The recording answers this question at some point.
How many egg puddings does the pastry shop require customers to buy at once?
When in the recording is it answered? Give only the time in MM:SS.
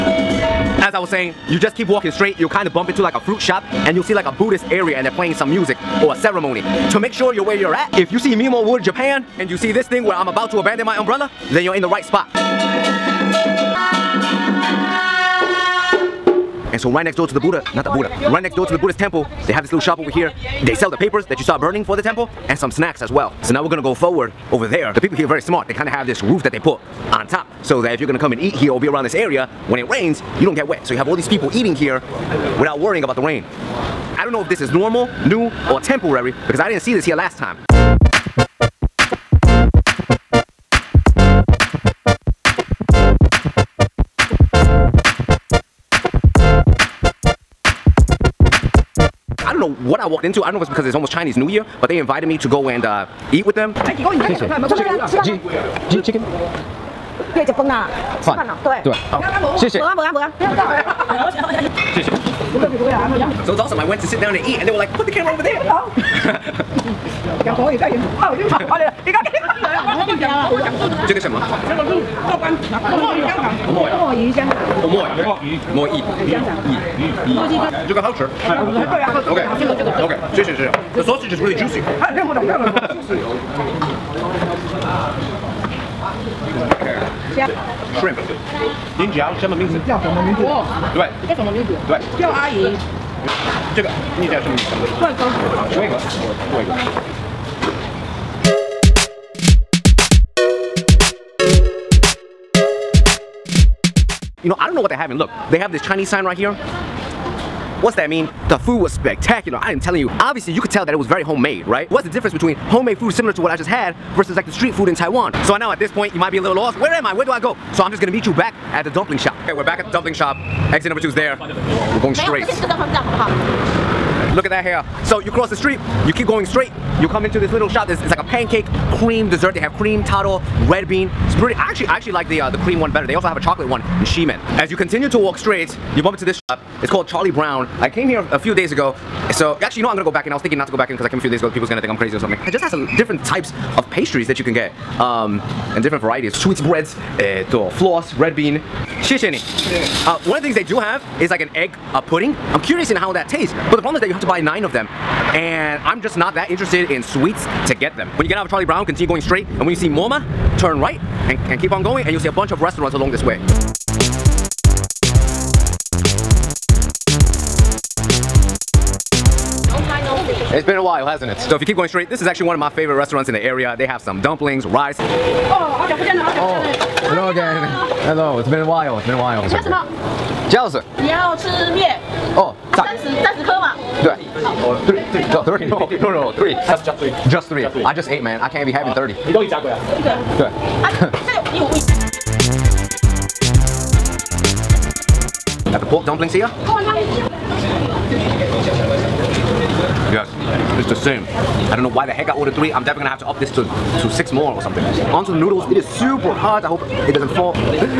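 02:34.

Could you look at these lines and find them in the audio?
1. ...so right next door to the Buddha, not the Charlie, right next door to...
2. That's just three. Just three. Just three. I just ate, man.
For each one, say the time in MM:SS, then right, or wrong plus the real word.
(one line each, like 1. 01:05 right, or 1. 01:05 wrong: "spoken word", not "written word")
1. 00:16 wrong: "Buddha", not "Charlie"
2. 03:06 right.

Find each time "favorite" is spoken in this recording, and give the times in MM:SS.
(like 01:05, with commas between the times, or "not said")
02:52.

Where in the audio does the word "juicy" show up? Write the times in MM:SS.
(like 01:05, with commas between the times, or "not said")
01:21.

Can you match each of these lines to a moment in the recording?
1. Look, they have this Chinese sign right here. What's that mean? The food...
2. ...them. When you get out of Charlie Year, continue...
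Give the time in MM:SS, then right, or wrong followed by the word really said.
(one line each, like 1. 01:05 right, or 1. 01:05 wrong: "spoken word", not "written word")
1. 01:45 right
2. 02:37 wrong: "Brown", not "Year".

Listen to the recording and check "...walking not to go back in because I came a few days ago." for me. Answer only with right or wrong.
wrong.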